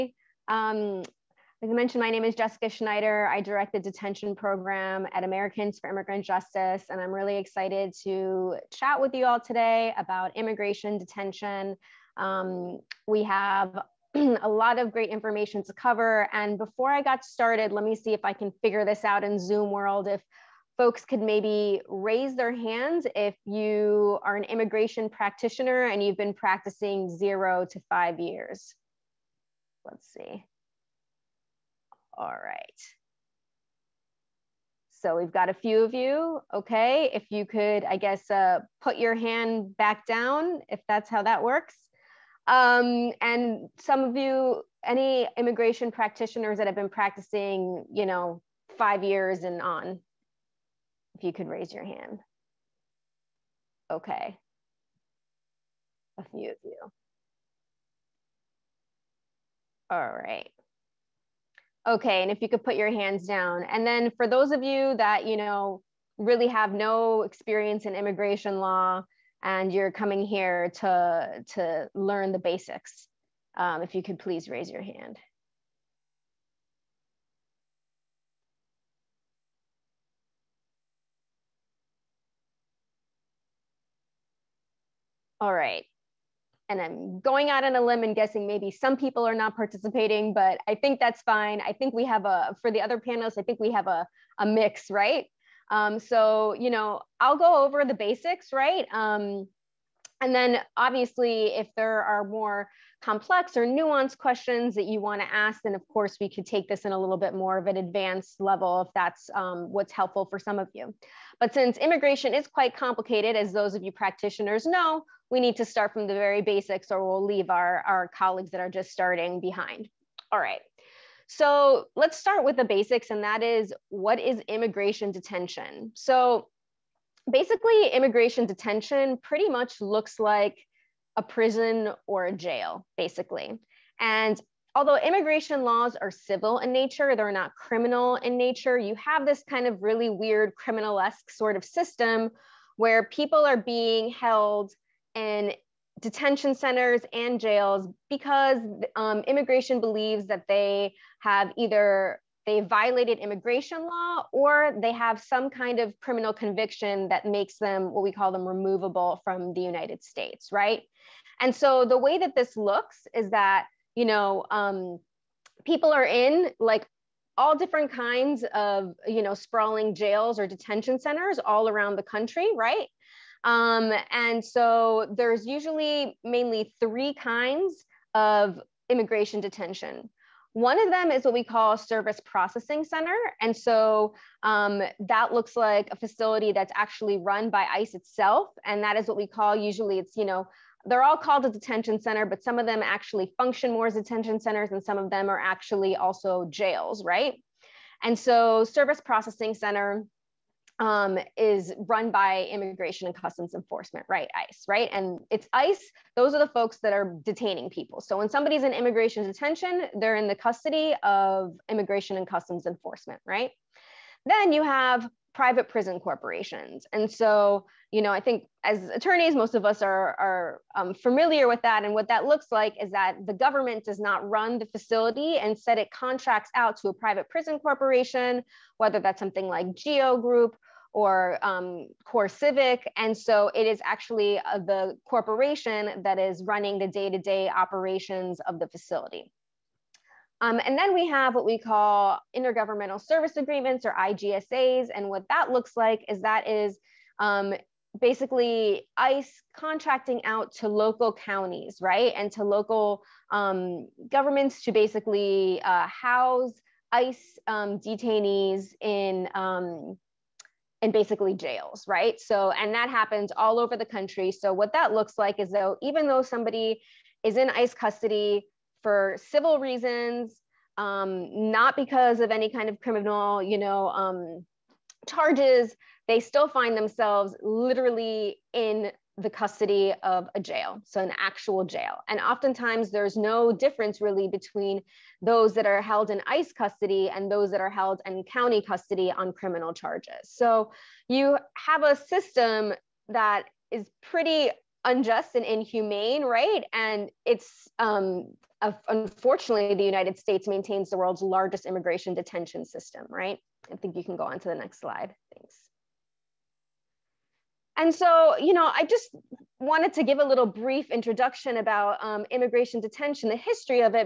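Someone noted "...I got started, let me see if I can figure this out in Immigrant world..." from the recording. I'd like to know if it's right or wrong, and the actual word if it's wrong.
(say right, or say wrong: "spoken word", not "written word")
wrong: "Zoom", not "Immigrant".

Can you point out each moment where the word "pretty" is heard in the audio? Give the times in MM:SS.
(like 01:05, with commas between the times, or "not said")
02:09, 04:54.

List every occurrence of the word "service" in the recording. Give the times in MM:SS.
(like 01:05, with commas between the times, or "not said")
03:01, 03:18, 04:03.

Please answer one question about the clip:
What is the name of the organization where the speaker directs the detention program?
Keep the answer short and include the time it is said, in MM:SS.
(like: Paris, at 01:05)
Americans for Immigrant Justice, at 00:05.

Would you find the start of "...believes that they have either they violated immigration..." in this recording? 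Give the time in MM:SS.
02:29.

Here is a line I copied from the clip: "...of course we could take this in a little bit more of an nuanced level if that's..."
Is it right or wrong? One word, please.
wrong.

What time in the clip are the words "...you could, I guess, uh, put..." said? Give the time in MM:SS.
00:37.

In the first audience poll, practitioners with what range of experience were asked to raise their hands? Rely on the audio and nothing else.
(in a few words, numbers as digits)
0 to 5 years.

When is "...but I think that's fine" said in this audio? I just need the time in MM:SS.
01:30.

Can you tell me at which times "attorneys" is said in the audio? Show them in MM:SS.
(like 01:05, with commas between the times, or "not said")
03:38.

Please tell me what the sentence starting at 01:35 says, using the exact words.
Um, so, you know, I'll go over the basics, right?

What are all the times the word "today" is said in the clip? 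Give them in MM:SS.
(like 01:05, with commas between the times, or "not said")
00:09.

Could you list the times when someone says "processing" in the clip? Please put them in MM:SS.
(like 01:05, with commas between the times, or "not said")
03:02, 03:19.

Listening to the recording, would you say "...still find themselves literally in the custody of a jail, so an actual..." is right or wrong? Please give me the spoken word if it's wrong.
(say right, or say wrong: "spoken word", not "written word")
right.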